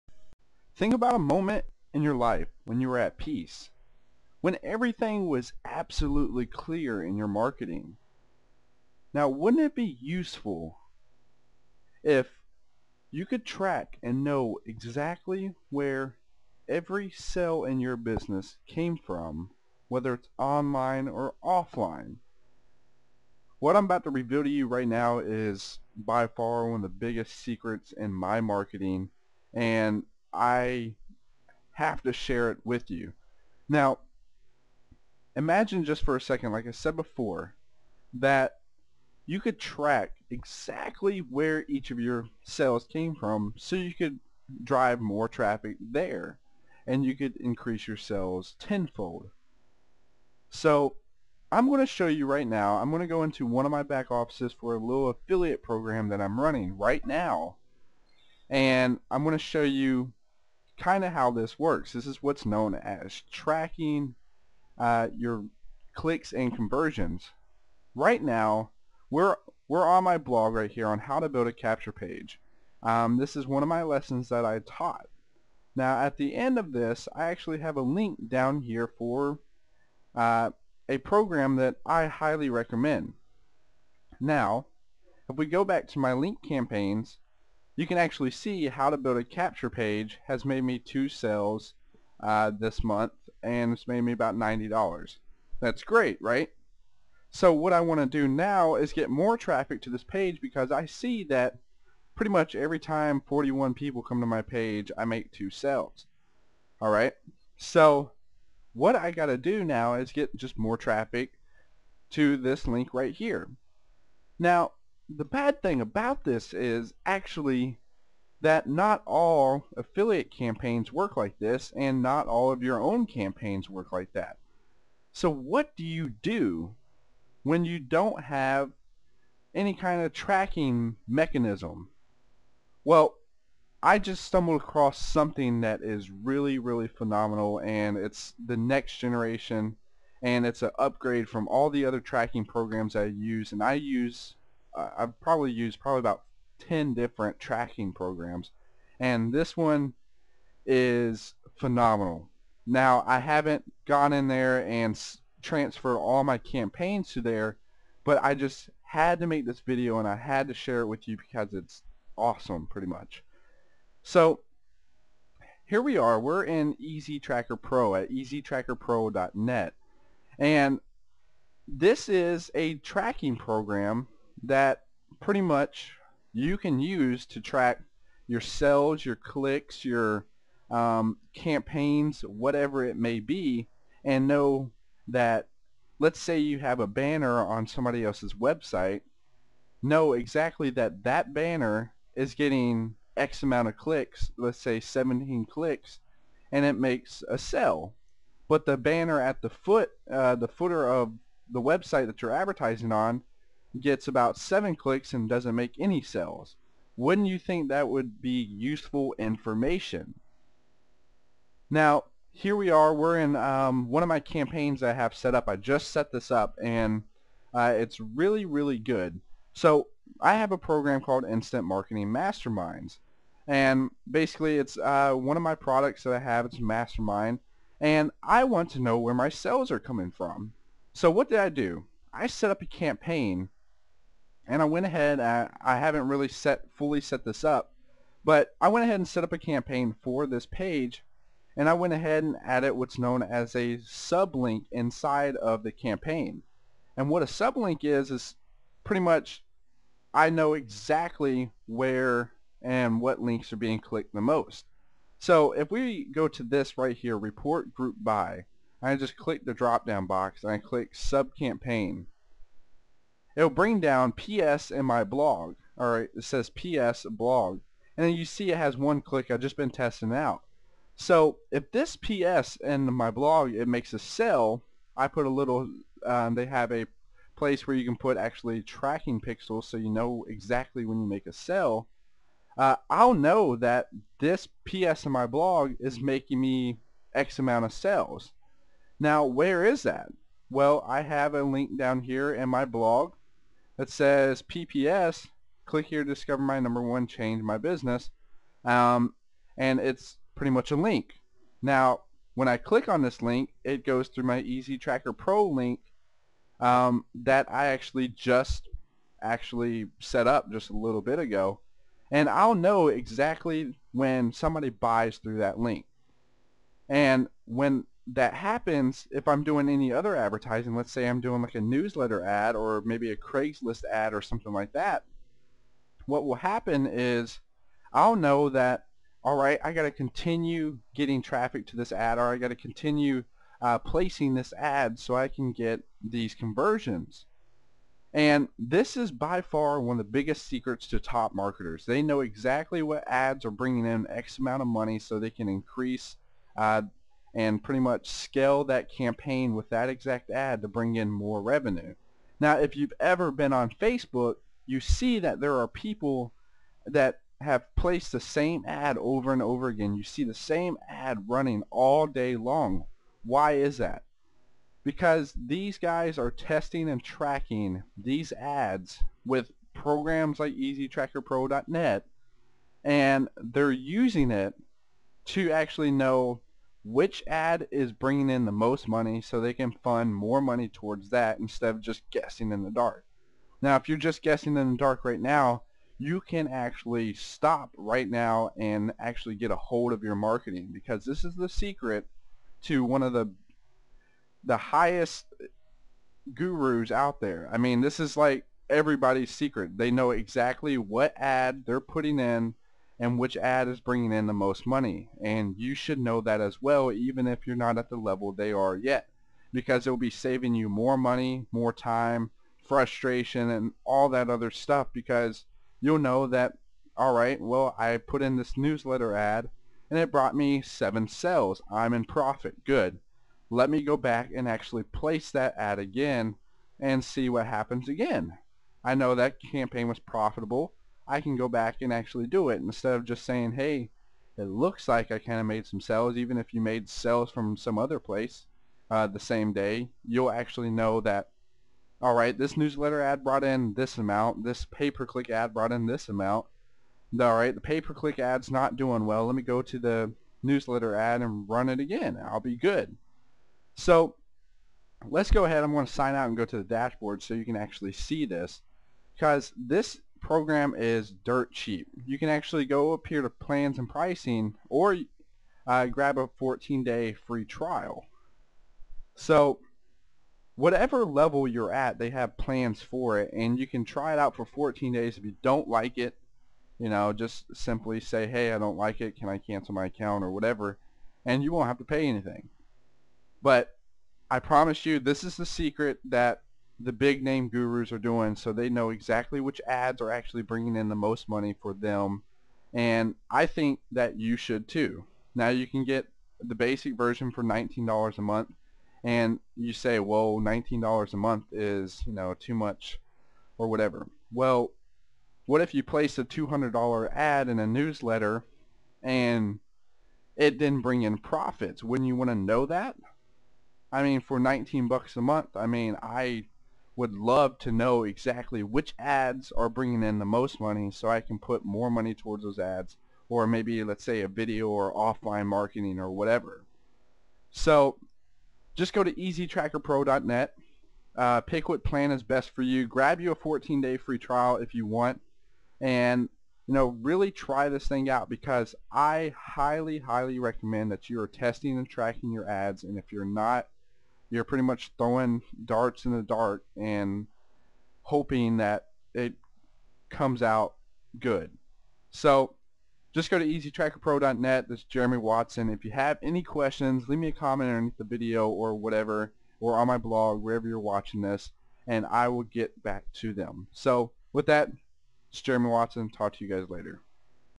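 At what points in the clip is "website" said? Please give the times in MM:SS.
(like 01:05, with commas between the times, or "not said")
03:08, 03:21.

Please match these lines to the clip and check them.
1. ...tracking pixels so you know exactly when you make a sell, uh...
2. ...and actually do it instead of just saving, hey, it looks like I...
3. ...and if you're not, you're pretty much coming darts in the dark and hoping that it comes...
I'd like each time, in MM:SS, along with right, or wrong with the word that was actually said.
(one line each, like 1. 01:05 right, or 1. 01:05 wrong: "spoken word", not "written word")
1. 04:38 right
2. 07:11 wrong: "saying", not "saving"
3. 09:02 wrong: "throwing", not "coming".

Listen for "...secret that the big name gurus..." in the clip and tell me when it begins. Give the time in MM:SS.
08:05.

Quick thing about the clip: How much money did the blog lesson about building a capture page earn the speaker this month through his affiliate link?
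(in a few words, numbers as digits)
$90.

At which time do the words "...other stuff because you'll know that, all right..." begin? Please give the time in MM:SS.
06:54.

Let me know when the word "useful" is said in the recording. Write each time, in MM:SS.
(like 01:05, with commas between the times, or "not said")
00:10, 03:28.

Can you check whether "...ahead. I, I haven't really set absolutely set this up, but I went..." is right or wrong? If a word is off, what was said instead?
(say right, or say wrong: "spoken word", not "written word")
wrong: "fully", not "absolutely".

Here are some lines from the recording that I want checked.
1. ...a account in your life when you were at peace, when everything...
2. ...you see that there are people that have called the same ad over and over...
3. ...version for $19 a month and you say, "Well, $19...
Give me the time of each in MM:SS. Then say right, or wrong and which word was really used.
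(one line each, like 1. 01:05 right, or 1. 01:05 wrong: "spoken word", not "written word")
1. 00:01 wrong: "moment", not "account"
2. 05:54 wrong: "placed", not "called"
3. 08:16 right.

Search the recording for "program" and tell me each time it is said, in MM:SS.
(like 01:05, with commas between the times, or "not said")
00:55, 01:20, 02:22, 02:27, 02:53, 03:40, 06:09, 07:40.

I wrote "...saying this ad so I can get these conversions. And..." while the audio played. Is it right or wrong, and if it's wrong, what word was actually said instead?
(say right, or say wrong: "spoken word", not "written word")
wrong: "placing", not "saying".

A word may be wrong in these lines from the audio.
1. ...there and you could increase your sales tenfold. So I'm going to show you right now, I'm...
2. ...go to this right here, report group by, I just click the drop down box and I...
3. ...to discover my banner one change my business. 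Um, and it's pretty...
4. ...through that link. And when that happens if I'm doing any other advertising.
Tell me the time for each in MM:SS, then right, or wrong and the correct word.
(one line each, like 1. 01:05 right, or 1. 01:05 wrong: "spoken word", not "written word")
1. 00:45 right
2. 04:16 right
3. 04:56 wrong: "number", not "banner"
4. 05:15 right.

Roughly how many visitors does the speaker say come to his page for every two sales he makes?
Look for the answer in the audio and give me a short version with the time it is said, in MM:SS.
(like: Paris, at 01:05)
41, at 01:43.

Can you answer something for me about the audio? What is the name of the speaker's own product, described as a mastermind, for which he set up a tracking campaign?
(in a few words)
Instant Marketing Masterminds.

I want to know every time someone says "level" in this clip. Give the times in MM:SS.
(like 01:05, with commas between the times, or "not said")
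06:47, 07:51.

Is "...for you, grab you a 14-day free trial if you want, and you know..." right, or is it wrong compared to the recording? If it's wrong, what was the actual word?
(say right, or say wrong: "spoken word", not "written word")
right.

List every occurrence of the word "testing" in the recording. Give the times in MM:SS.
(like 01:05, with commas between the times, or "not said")
04:29, 06:06, 09:01.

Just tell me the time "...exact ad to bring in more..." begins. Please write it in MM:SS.
05:49.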